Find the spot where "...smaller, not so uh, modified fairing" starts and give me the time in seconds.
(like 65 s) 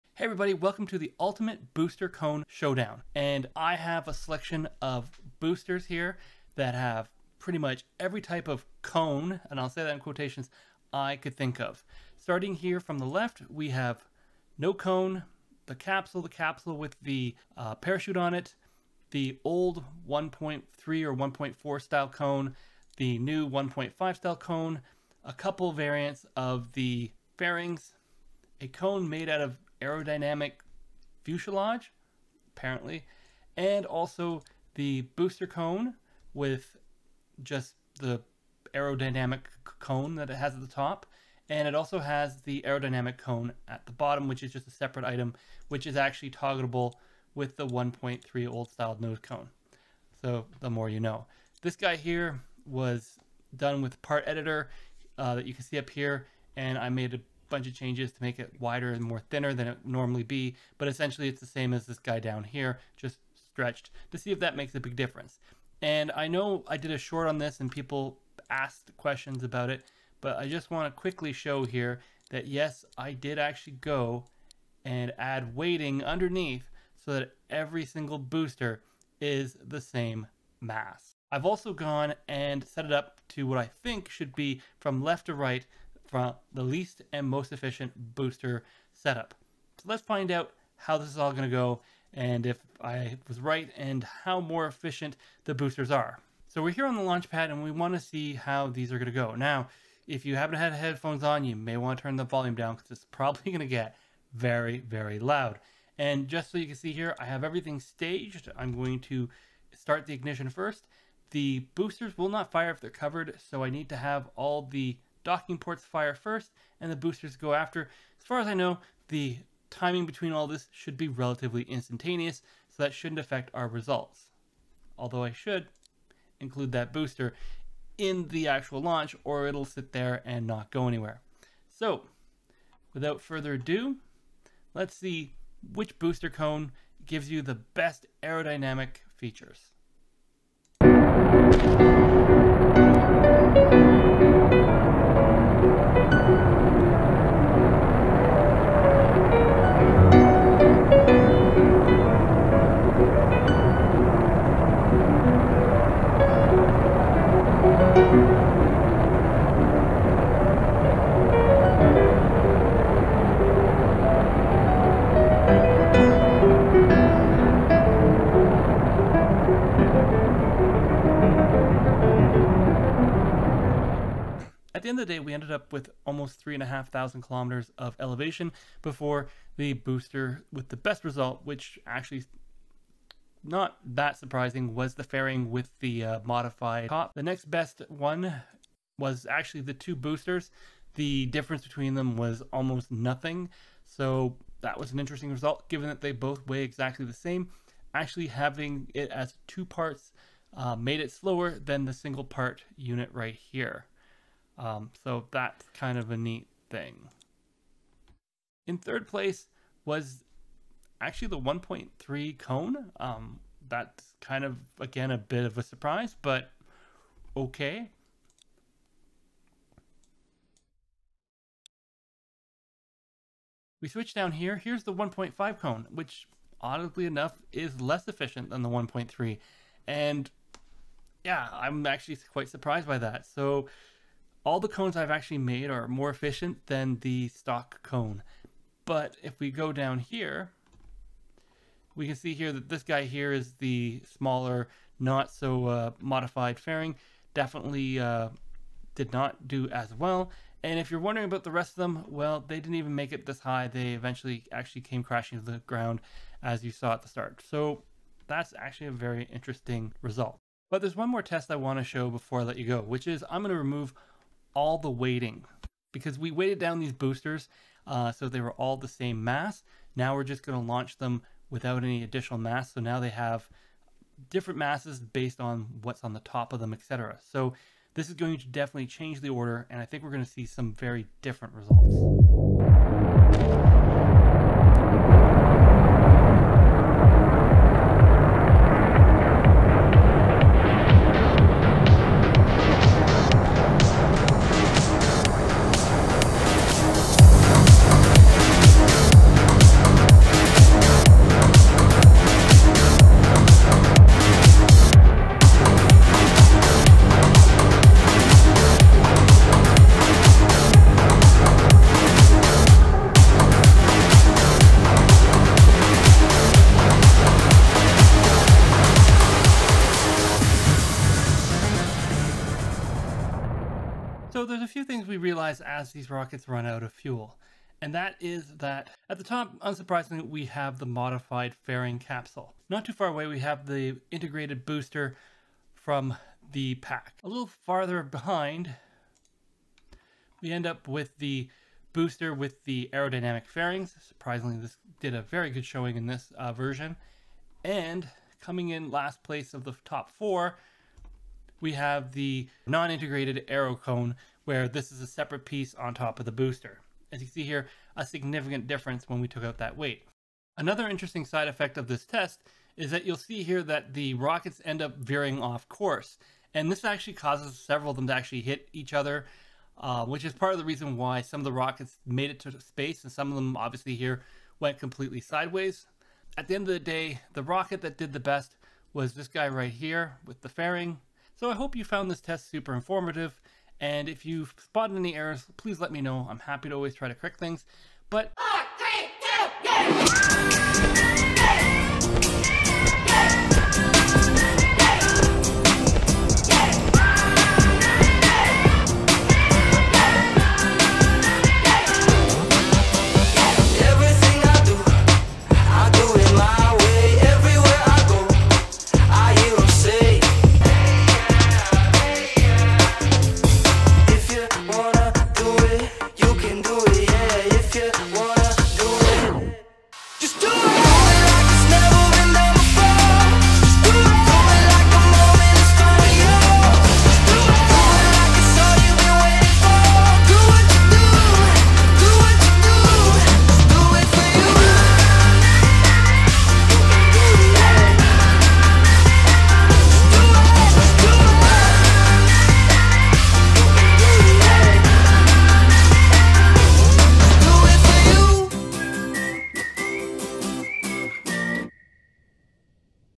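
244 s.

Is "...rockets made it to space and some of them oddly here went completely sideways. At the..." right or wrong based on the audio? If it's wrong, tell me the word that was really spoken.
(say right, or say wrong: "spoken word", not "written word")
wrong: "obviously", not "oddly".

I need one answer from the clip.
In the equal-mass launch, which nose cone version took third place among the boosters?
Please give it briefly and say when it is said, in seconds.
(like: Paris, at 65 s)
1.3 cone, at 211 s.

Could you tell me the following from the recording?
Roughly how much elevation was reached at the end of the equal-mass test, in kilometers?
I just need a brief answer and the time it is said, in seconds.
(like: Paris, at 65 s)
3,500 kilometers, at 176 s.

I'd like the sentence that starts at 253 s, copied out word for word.
They eventually actually came crashing to the ground as you saw at the start.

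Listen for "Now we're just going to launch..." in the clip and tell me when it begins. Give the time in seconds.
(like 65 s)
269 s.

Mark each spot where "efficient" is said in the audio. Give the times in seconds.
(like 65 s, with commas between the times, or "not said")
87 s, 94 s, 228 s, 236 s.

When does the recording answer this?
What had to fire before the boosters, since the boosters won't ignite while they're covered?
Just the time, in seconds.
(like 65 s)
115 s.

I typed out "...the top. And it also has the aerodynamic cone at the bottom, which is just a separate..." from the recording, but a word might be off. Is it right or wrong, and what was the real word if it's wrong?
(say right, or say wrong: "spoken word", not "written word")
right.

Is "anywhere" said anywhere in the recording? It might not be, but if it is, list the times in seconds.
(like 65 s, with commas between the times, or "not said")
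130 s.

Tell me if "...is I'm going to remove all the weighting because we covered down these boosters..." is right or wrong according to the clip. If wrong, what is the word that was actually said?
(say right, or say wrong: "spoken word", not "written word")
wrong: "weighted", not "covered".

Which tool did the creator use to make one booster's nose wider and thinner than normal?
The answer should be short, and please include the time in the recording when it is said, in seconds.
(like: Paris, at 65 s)
Part editor, at 54 s.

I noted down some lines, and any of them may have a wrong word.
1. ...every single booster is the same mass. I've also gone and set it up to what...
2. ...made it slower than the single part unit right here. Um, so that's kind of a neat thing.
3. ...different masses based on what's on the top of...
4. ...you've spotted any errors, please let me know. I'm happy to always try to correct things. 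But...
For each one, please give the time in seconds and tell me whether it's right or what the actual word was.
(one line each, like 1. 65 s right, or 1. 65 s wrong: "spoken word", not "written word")
1. 77 s right
2. 200 s right
3. 274 s right
4. 384 s right.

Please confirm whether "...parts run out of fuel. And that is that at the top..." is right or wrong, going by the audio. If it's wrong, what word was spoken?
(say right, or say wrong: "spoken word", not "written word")
wrong: "rockets", not "parts".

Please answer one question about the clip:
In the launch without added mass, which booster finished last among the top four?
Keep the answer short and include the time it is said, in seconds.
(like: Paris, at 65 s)
Non-integrated aero cone, at 352 s.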